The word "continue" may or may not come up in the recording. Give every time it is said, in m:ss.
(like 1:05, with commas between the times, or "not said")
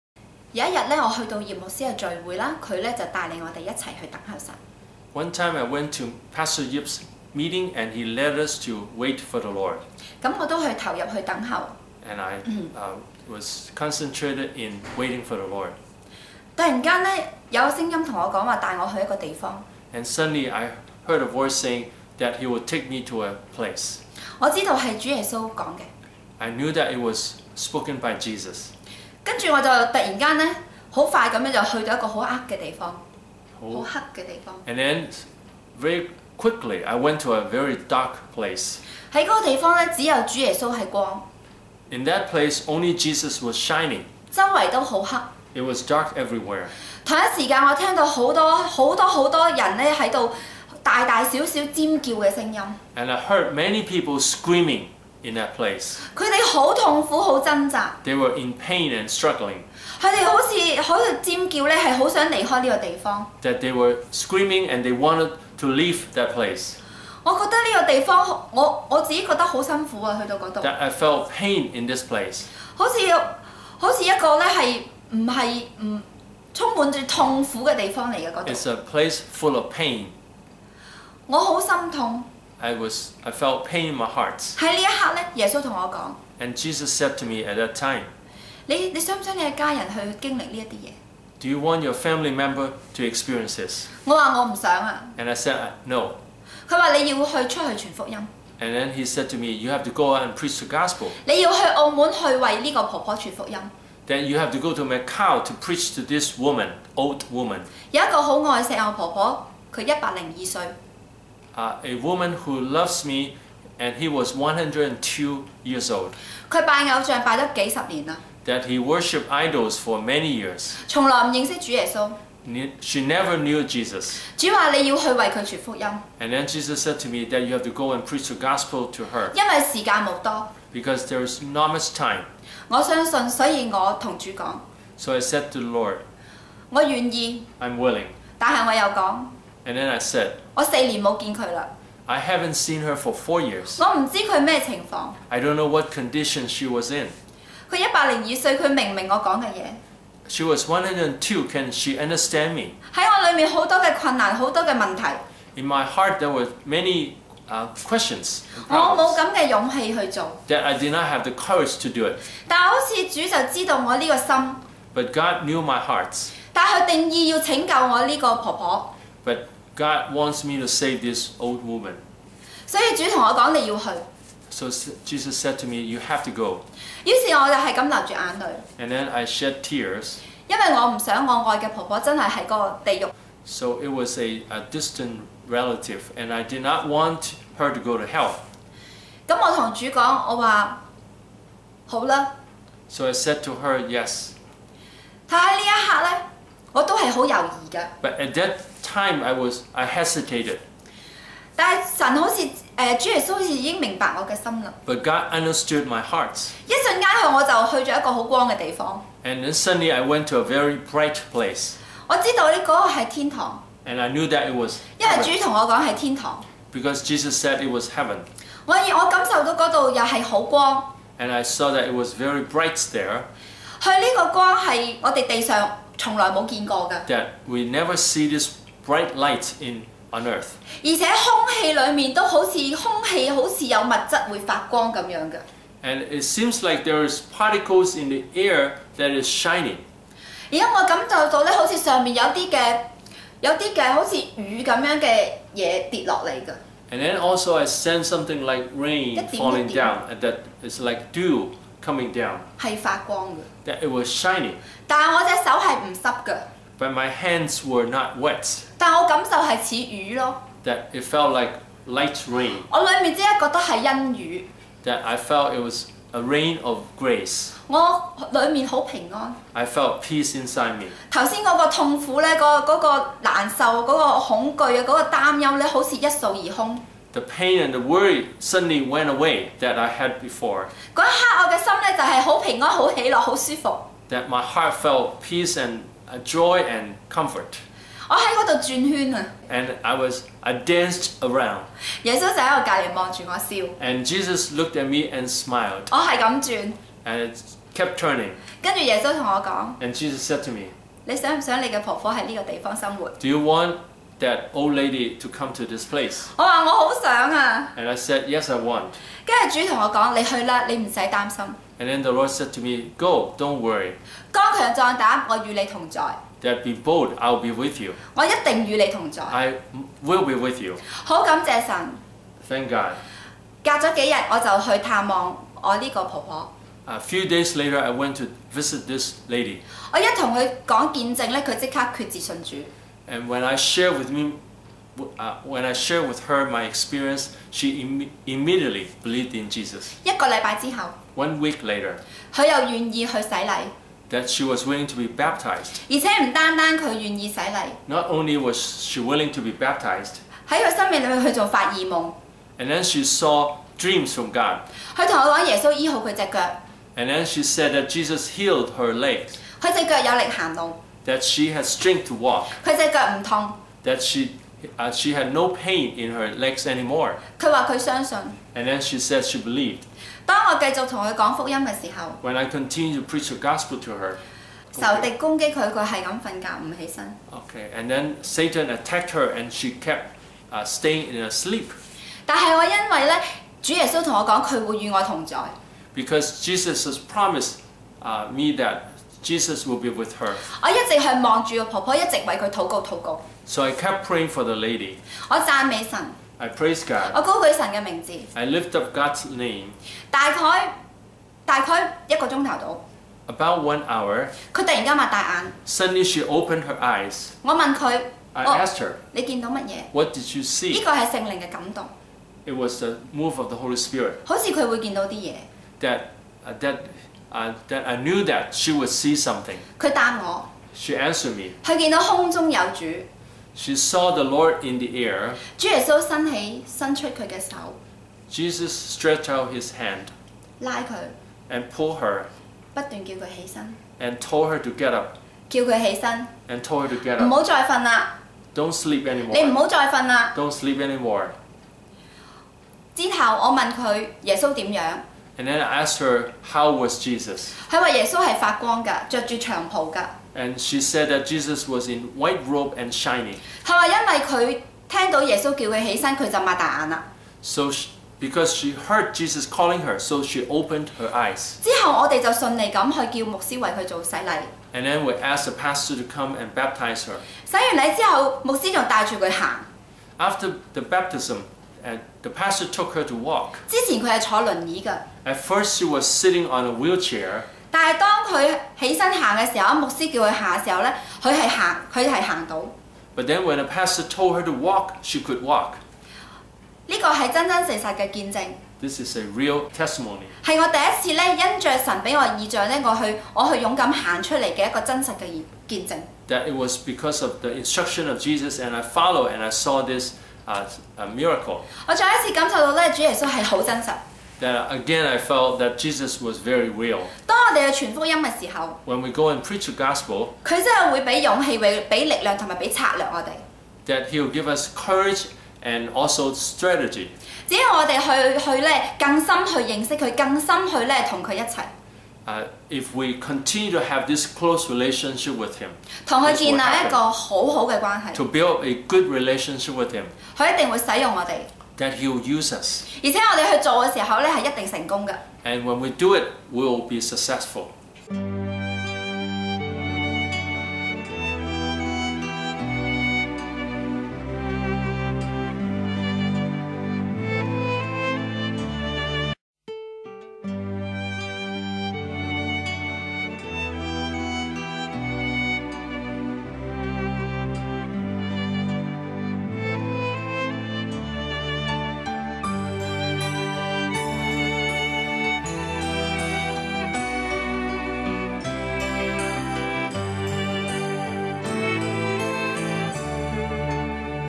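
6:12, 8:43.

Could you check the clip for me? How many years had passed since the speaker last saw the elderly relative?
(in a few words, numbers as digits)
4.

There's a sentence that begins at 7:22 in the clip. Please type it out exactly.
之 後 我 問 佢 耶 穌 點 樣？ and then I asked her, how was Jesus?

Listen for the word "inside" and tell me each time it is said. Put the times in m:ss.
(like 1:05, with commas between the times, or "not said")
4:30.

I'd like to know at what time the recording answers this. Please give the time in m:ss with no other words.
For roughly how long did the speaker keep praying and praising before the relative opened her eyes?
6:43.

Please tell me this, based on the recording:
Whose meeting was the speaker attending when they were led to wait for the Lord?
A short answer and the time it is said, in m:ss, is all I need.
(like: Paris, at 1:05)
Pastor Yip, at 0:06.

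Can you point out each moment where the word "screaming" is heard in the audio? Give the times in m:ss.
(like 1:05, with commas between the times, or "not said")
0:54, 1:04.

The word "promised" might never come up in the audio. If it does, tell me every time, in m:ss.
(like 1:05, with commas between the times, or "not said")
6:26.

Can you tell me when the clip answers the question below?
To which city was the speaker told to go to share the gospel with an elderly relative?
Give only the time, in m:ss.
1:44.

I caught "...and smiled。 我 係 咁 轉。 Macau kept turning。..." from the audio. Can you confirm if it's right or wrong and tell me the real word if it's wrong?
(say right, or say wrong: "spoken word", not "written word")
wrong: "And", not "Macau".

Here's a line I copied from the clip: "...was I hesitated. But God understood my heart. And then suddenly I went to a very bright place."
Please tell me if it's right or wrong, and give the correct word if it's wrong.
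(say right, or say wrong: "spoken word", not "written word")
right.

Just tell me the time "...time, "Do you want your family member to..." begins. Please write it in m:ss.
1:27.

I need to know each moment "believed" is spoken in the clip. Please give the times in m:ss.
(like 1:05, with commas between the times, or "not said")
5:39, 6:09.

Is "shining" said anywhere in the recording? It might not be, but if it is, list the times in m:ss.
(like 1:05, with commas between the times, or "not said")
0:43, 3:59, 4:14, 7:32.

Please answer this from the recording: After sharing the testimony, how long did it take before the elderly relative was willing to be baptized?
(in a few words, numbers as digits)
One week.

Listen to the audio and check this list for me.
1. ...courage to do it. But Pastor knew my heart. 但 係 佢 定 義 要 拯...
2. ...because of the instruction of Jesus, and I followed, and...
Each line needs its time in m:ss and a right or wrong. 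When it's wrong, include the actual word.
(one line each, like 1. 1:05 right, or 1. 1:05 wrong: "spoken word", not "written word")
1. 2:41 wrong: "God", not "Pastor"
2. 8:16 right.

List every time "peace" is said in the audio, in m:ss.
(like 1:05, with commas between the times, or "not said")
4:30, 4:45.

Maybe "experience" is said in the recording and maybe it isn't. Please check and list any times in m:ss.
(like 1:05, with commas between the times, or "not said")
1:33, 5:36.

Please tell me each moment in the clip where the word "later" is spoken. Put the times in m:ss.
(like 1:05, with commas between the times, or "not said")
5:27, 5:41.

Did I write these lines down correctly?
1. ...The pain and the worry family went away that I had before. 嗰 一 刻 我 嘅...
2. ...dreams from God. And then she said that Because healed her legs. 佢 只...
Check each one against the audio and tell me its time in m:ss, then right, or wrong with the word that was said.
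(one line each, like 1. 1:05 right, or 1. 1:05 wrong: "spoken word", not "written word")
1. 4:37 wrong: "suddenly", not "family"
2. 5:53 wrong: "Jesus", not "Because".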